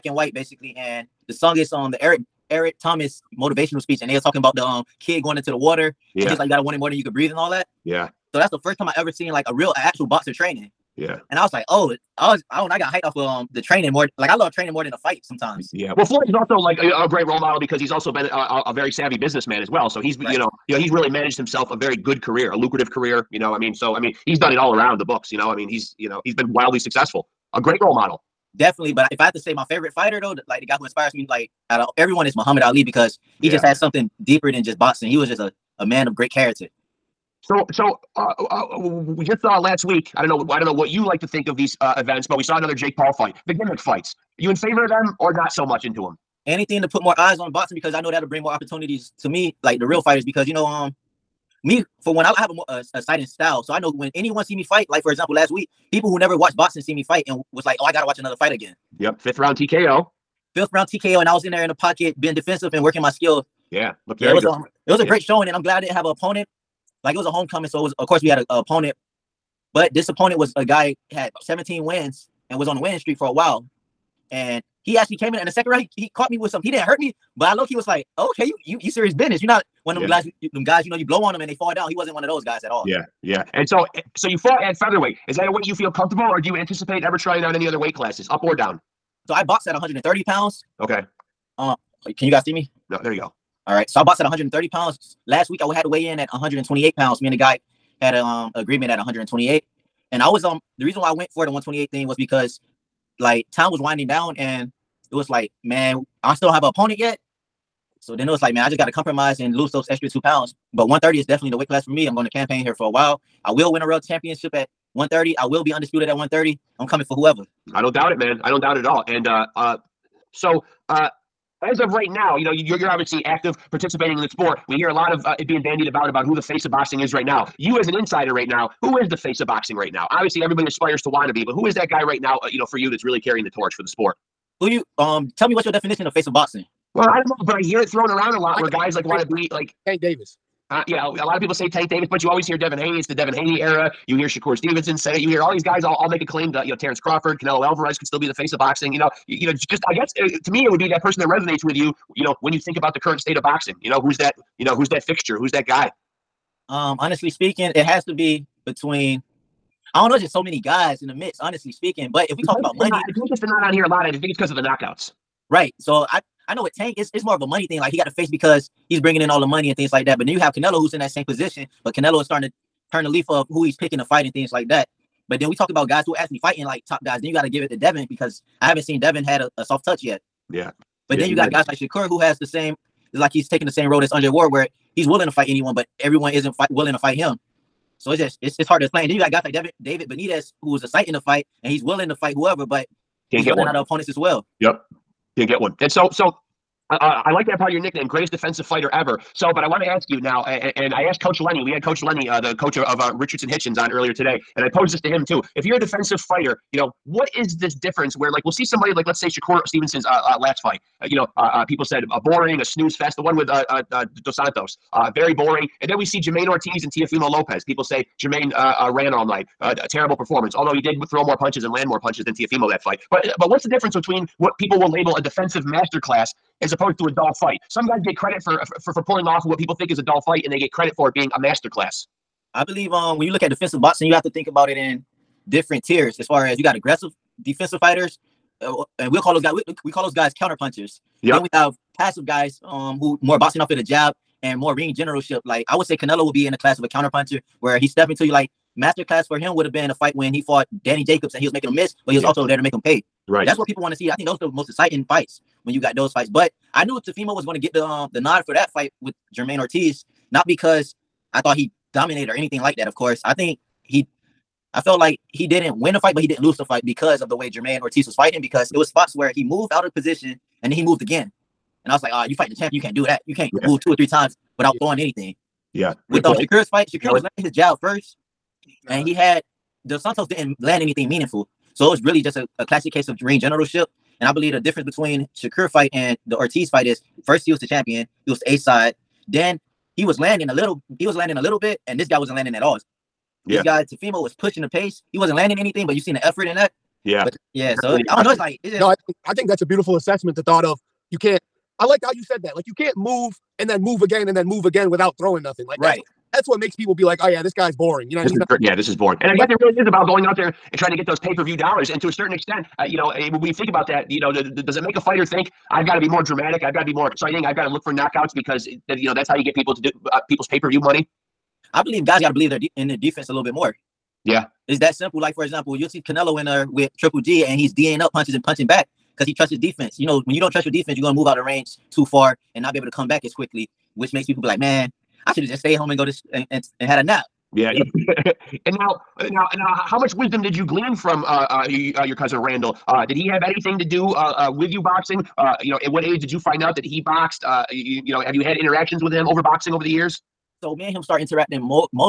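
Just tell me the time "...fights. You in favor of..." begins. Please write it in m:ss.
0:43.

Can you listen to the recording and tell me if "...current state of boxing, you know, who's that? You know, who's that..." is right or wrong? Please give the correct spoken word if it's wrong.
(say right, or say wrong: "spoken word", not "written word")
right.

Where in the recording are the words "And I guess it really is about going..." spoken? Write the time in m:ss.
5:09.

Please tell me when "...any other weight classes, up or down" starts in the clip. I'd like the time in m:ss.
1:27.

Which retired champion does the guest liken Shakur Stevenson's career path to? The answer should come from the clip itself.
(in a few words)
Andre Ward.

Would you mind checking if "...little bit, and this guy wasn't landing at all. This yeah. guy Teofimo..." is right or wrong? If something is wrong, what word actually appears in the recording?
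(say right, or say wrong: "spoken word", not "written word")
right.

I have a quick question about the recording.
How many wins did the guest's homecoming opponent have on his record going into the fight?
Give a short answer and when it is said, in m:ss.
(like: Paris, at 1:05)
17, at 1:11.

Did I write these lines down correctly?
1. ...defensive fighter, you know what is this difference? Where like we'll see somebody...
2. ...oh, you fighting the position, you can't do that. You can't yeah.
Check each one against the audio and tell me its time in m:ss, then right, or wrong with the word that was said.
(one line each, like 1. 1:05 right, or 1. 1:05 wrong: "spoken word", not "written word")
1. 3:25 right
2. 4:32 wrong: "champion", not "position".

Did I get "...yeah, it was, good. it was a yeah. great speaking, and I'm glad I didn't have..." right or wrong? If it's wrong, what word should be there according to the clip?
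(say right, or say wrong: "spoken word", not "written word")
wrong: "showing", not "speaking".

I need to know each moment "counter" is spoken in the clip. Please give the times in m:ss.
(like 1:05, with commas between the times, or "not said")
4:00, 4:06.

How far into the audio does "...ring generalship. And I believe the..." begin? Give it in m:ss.
4:43.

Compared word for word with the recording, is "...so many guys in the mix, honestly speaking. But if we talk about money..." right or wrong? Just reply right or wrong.
right.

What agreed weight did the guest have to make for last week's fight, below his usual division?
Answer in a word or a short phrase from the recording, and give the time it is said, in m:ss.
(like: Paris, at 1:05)
128 pounds, at 1:36.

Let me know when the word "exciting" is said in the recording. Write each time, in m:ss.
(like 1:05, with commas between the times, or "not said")
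4:14, 5:17.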